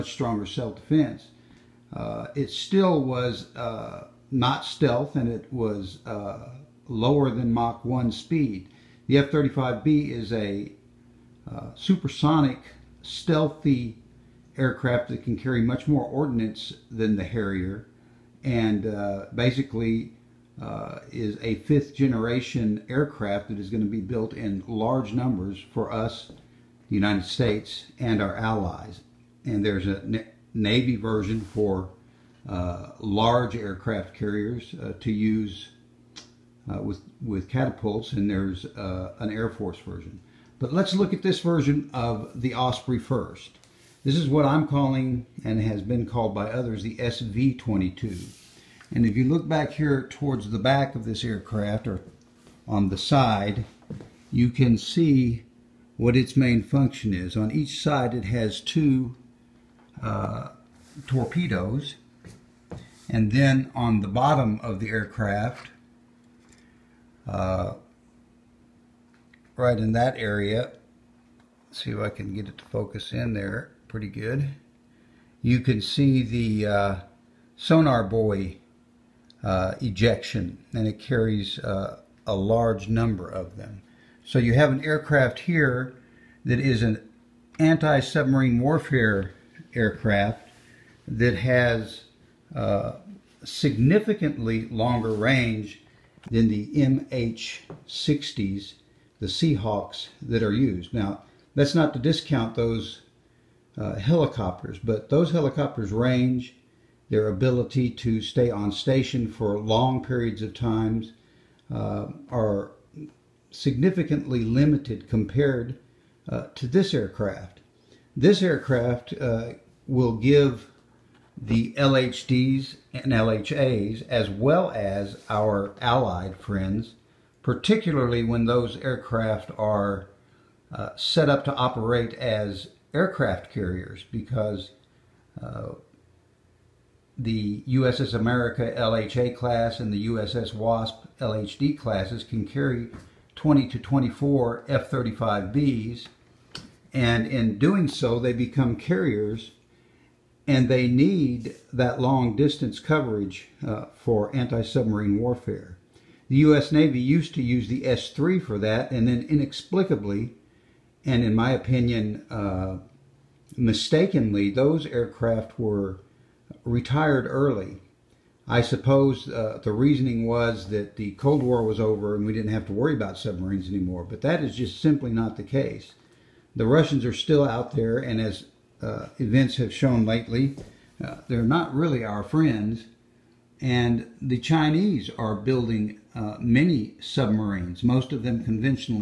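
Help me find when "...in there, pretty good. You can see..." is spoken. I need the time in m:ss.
1:13.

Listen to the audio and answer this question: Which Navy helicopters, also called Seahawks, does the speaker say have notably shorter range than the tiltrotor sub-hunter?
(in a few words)
MH-60s.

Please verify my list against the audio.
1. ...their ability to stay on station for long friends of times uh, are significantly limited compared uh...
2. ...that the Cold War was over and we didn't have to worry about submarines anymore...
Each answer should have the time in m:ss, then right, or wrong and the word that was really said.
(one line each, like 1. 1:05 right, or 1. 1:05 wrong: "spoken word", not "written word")
1. 1:47 wrong: "periods", not "friends"
2. 2:50 right.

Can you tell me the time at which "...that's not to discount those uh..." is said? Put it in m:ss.
1:41.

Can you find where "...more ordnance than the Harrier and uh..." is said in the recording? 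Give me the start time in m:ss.
0:15.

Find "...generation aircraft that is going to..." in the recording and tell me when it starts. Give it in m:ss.
0:21.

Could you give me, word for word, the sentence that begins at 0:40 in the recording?
But let's look at this version of the Osprey first.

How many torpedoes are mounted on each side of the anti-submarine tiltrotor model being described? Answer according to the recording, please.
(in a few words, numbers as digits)
2.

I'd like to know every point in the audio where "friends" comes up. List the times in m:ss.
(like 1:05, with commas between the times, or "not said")
2:06, 3:02.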